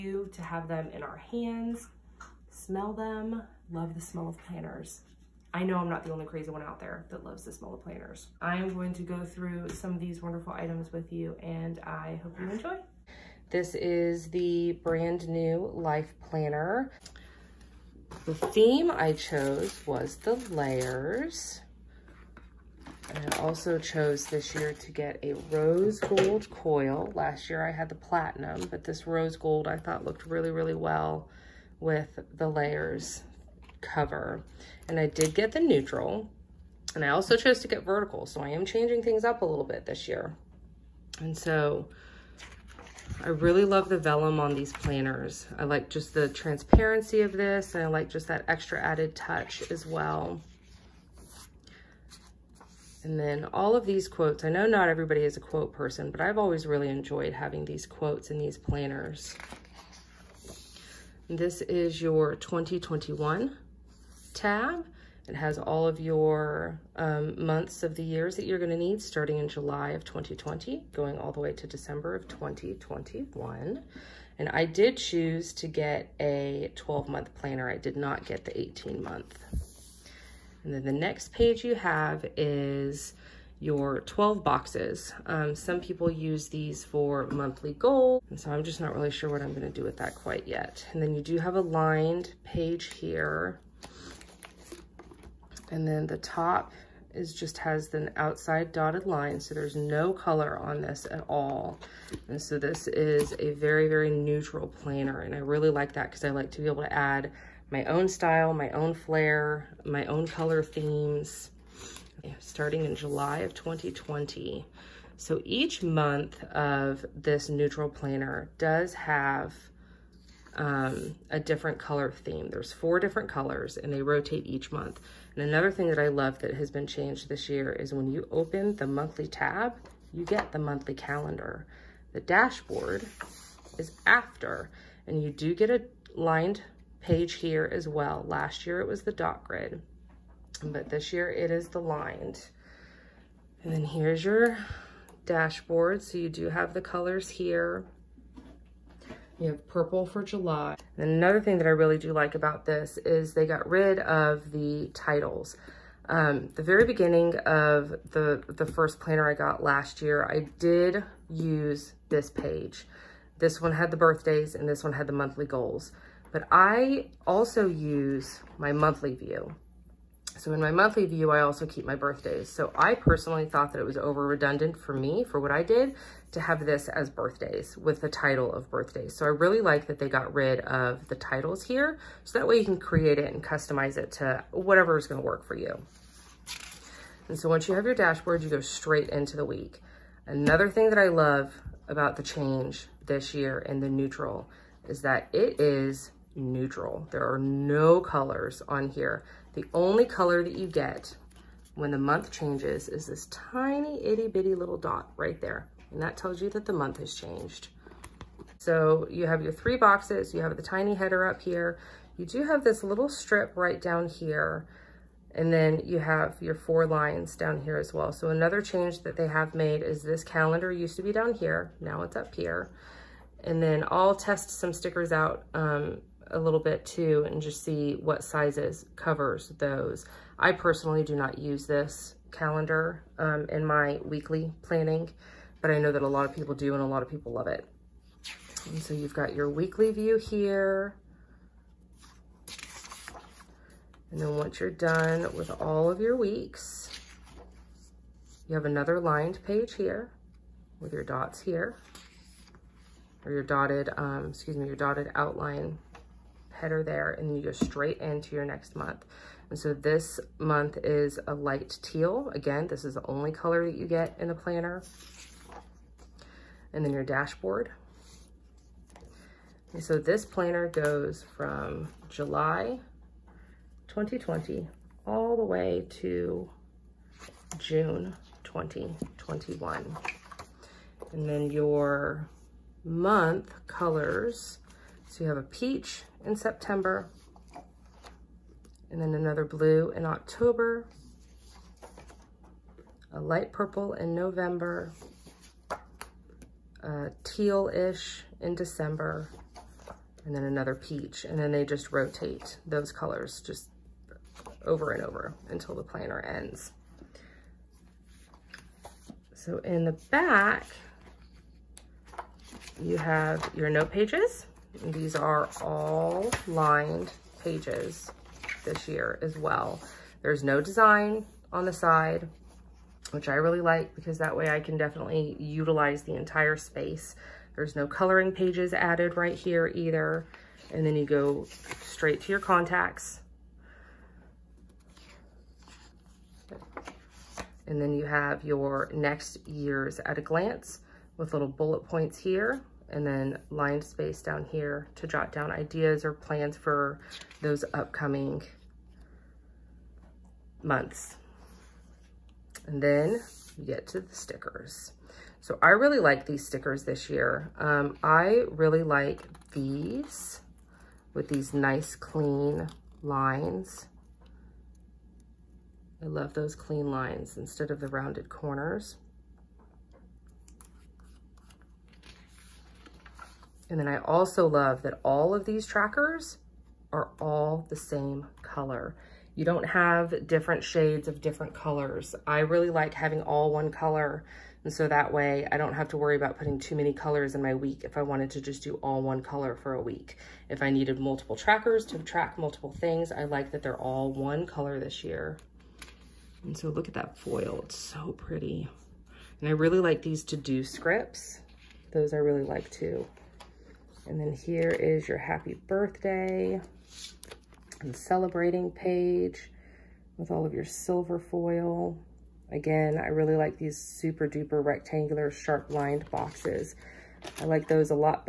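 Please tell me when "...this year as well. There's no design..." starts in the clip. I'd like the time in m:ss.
5:18.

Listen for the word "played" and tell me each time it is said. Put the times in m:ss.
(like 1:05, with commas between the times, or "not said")
not said.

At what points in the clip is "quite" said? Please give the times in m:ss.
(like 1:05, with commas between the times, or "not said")
1:30.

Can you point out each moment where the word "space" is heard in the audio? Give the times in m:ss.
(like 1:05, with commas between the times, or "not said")
5:26, 5:43.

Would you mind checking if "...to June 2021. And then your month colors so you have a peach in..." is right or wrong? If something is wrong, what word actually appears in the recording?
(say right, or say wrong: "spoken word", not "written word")
right.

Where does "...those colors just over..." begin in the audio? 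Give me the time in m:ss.
5:02.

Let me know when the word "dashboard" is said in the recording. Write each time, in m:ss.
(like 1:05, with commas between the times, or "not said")
2:12, 2:25, 3:07, 4:27.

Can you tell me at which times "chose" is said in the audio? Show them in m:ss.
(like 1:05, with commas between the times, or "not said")
0:19, 0:23, 0:37.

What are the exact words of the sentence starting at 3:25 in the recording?
And that tells you that the month has changed.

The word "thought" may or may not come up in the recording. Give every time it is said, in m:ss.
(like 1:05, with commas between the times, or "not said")
0:29, 2:53.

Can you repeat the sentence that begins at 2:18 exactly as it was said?
Last year it was the dot grid, but this year it is the lined.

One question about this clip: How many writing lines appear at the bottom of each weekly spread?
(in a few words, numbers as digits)
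4.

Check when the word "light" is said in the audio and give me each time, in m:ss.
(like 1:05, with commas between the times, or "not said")
4:21, 4:53.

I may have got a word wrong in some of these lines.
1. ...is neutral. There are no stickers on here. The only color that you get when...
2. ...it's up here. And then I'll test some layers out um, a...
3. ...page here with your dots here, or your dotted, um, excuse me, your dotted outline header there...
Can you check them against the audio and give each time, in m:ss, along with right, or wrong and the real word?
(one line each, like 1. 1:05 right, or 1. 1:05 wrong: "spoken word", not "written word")
1. 3:15 wrong: "colors", not "stickers"
2. 3:42 wrong: "stickers", not "layers"
3. 4:09 right.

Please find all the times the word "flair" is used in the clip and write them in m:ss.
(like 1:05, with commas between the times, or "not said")
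1:48.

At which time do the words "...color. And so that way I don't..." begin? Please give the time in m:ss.
6:23.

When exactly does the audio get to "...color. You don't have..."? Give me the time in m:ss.
6:18.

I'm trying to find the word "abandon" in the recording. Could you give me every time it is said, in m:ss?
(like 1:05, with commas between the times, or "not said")
not said.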